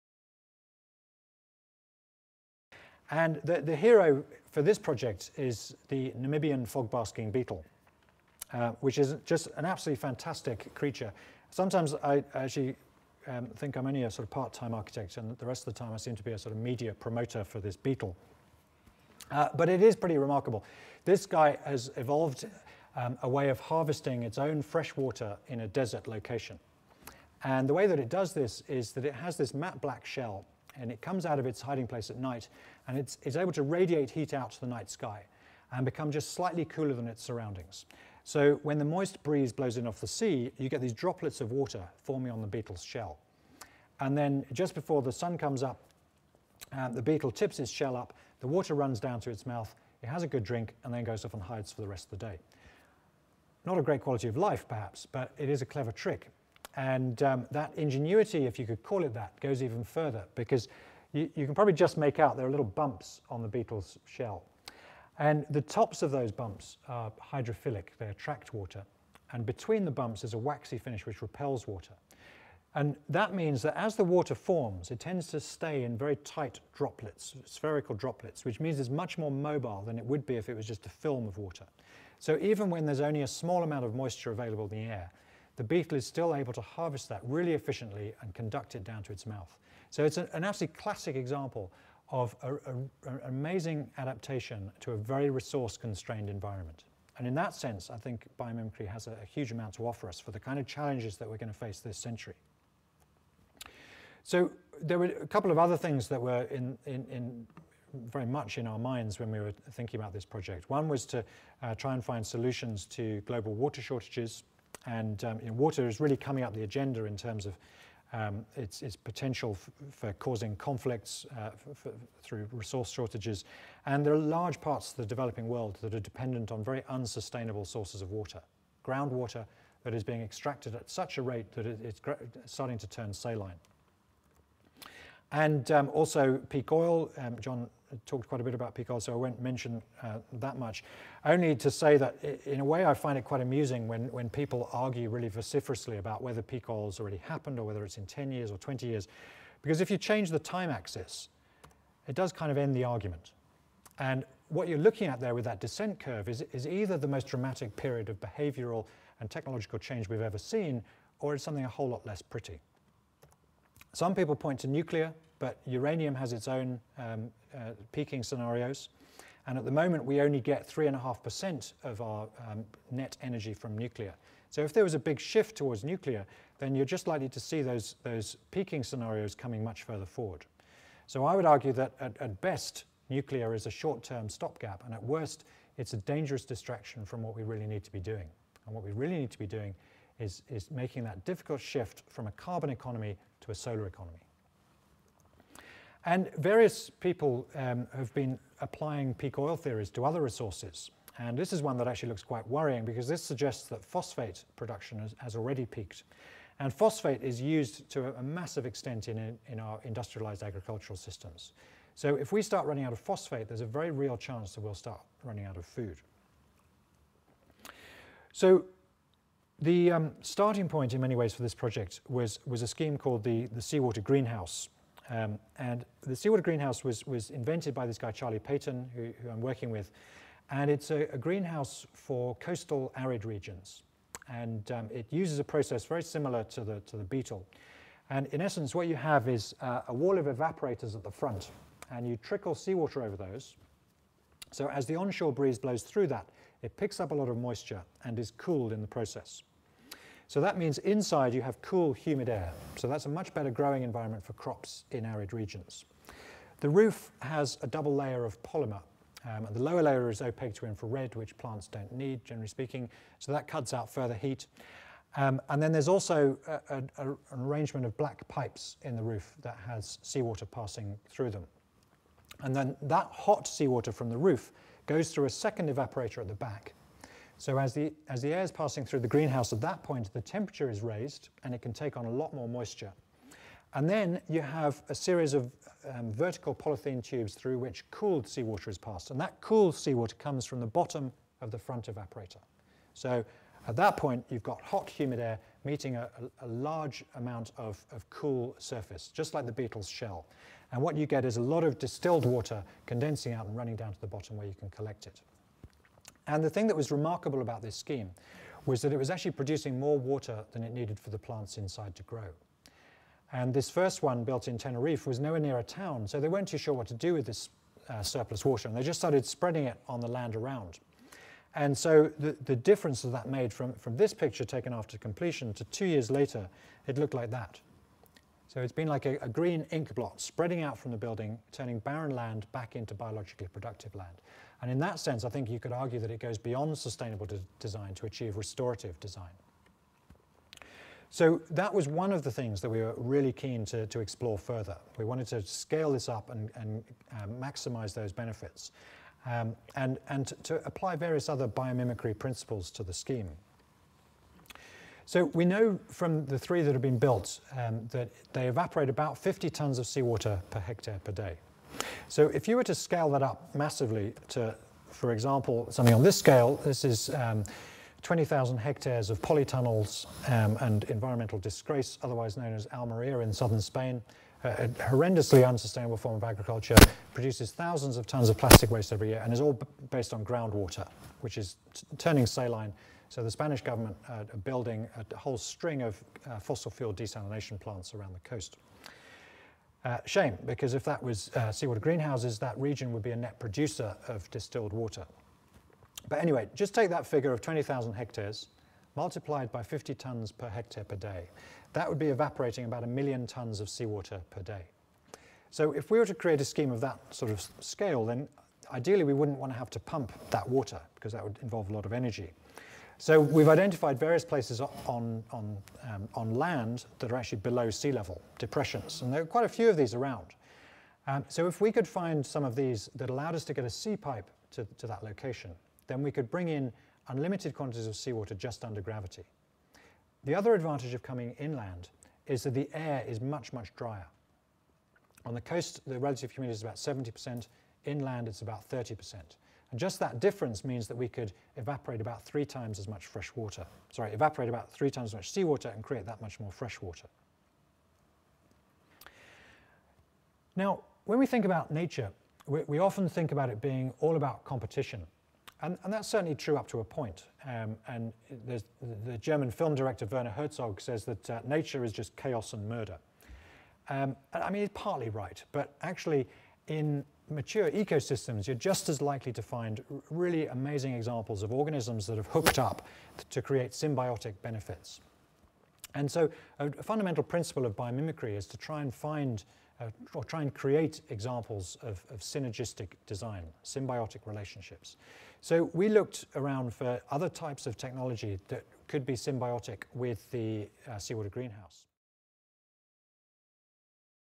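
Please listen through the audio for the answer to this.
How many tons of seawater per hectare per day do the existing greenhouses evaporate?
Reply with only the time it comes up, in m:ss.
5:59.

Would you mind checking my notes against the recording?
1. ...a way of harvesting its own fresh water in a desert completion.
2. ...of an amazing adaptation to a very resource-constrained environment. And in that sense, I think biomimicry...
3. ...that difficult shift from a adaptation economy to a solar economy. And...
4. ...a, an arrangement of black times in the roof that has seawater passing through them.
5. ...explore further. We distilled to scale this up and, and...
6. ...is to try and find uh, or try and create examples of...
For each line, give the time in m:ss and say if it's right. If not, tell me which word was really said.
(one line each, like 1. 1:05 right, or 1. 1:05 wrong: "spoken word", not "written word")
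1. 0:23 wrong: "location", not "completion"
2. 1:32 right
3. 3:11 wrong: "carbon", not "adaptation"
4. 4:26 wrong: "pipes", not "times"
5. 5:43 wrong: "wanted", not "distilled"
6. 7:58 right.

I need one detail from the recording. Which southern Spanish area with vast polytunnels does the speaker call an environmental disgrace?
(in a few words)
Almeria.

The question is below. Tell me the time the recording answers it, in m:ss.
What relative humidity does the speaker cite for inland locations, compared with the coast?
7:18.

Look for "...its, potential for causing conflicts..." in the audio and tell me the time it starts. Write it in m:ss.
1:58.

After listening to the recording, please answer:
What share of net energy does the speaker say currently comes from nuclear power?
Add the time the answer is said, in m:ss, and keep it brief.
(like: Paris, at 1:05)
3.5%, at 2:50.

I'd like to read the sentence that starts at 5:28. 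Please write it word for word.
So it's been like a, a green ink blot spreading out from the building, turning barren land back into biologically productive land.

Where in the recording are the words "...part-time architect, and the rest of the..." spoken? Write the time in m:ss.
0:14.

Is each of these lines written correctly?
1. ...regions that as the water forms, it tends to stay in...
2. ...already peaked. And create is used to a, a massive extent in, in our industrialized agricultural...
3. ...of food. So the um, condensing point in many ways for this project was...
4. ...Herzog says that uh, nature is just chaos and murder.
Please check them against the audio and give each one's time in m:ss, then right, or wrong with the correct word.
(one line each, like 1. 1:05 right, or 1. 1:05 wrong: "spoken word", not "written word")
1. 1:13 wrong: "means", not "regions"
2. 3:25 wrong: "phosphate", not "create"
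3. 3:35 wrong: "starting", not "condensing"
4. 7:40 right.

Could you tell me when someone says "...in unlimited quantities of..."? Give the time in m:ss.
7:06.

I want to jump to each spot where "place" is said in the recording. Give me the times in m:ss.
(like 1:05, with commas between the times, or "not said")
0:31, 6:54.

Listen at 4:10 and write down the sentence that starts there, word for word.
So that means inside you have cool, humid air.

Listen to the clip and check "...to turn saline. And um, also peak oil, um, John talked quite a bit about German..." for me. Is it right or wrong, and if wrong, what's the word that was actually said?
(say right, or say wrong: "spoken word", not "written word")
wrong: "Picard", not "German".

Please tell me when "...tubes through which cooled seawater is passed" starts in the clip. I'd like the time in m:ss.
4:47.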